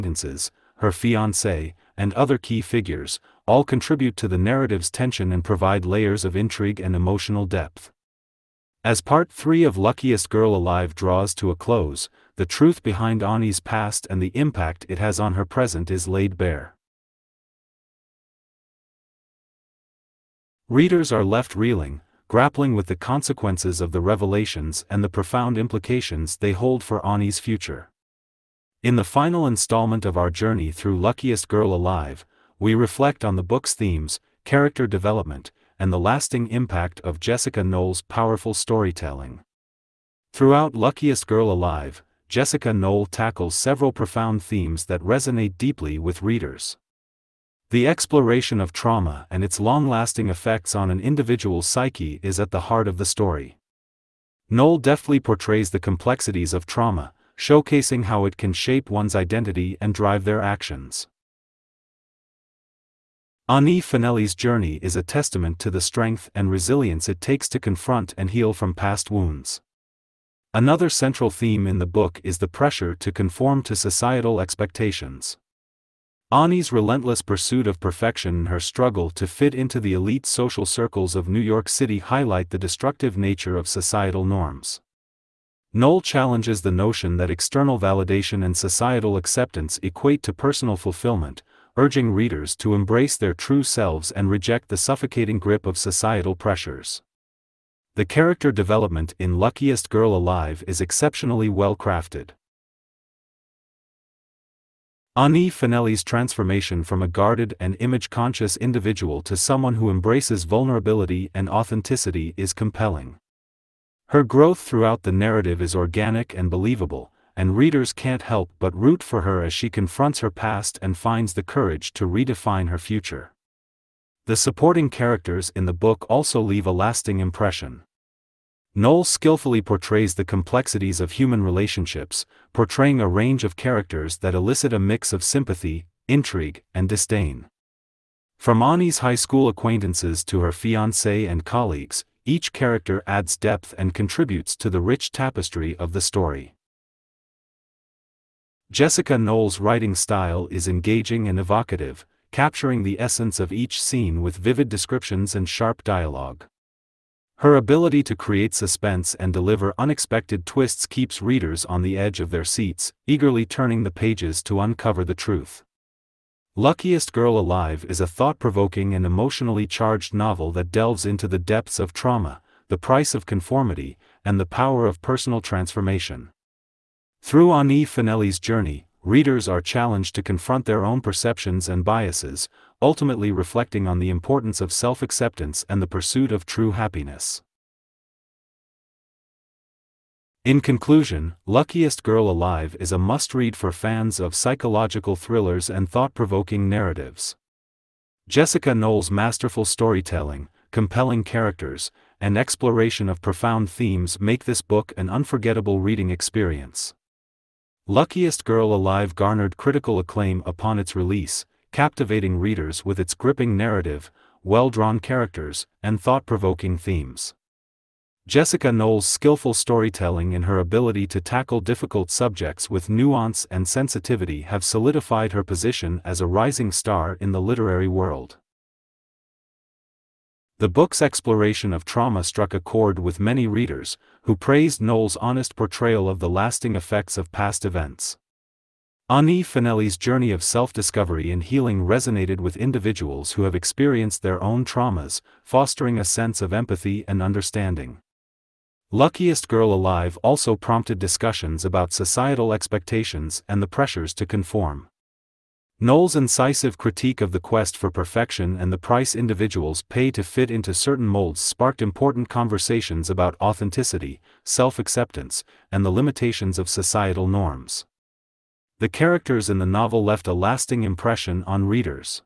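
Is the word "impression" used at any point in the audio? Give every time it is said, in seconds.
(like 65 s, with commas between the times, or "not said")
127 s, 270 s.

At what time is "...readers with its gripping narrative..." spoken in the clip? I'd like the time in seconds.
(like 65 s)
212 s.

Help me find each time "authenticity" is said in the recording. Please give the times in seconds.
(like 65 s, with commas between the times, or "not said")
111 s, 263 s.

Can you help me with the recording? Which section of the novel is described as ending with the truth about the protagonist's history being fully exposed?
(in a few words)
Part 3.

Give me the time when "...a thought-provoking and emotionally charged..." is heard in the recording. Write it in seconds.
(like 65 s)
167 s.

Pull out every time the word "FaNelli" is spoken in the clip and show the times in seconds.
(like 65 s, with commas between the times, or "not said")
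63 s, 105 s, 177 s, 239 s.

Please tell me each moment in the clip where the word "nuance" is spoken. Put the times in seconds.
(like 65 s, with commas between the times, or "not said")
222 s.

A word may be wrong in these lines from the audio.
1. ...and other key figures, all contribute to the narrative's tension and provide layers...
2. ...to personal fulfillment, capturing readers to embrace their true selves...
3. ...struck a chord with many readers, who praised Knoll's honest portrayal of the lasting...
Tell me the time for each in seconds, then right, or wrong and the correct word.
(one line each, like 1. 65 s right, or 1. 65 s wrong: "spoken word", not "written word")
1. 1 s right
2. 90 s wrong: "urging", not "capturing"
3. 232 s right.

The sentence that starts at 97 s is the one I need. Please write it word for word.
The character development in Luckiest Girl Alive is exceptionally well crafted.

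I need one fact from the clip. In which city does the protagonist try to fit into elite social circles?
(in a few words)
New York City.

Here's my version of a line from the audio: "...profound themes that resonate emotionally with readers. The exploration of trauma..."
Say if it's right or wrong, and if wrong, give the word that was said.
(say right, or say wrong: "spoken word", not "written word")
wrong: "deeply", not "emotionally".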